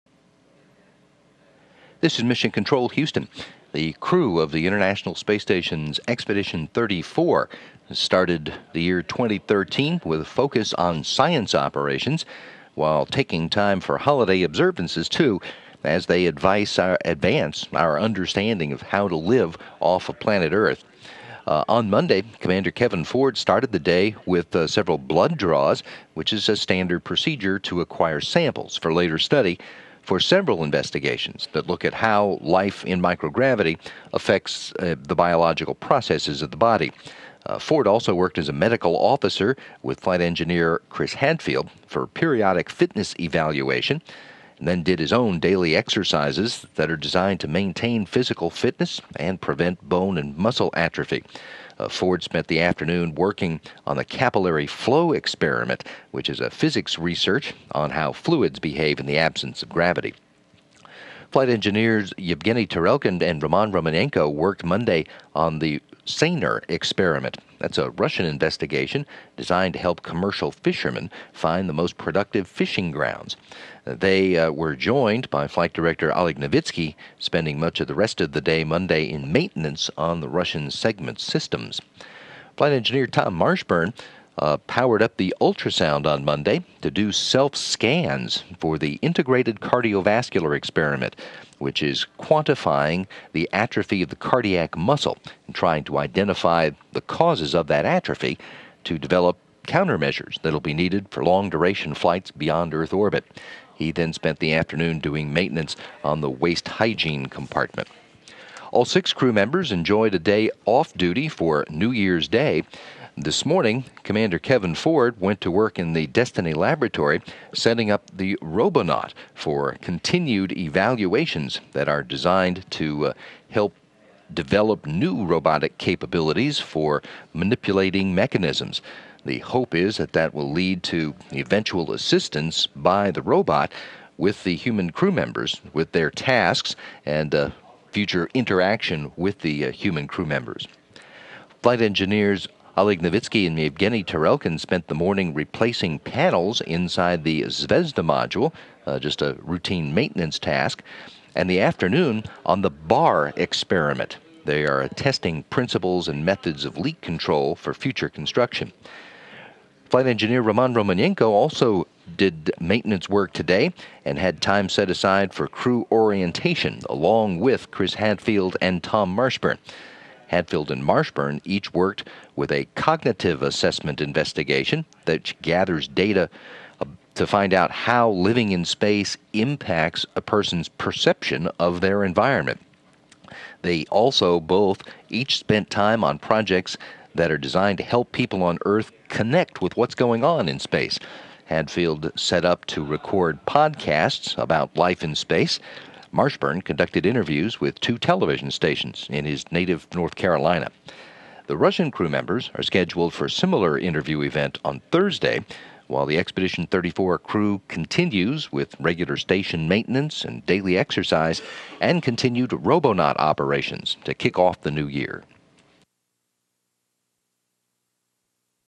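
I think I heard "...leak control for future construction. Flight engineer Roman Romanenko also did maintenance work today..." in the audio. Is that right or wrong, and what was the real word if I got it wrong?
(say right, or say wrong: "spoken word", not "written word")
right.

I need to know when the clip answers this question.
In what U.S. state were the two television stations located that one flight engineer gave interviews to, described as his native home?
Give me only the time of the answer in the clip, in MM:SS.
03:19.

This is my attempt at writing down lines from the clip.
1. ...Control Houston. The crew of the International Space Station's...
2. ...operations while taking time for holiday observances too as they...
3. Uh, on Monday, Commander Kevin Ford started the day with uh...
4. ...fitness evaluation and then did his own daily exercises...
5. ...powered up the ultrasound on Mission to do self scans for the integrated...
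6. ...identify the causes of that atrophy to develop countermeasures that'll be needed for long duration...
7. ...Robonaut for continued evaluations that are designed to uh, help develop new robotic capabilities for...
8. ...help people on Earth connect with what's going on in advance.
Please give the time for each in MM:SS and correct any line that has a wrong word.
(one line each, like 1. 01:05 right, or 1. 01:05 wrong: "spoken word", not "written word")
1. 00:02 right
2. 00:11 right
3. 00:21 right
4. 00:42 right
5. 01:24 wrong: "Monday", not "Mission"
6. 01:35 right
7. 01:58 right
8. 03:07 wrong: "space", not "advance".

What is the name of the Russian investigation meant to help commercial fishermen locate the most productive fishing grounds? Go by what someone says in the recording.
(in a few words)
Seiner.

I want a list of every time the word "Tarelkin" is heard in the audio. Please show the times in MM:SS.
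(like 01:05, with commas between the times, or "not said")
01:02, 02:24.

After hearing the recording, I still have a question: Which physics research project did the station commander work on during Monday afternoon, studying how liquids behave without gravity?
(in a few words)
capillary flow experiment.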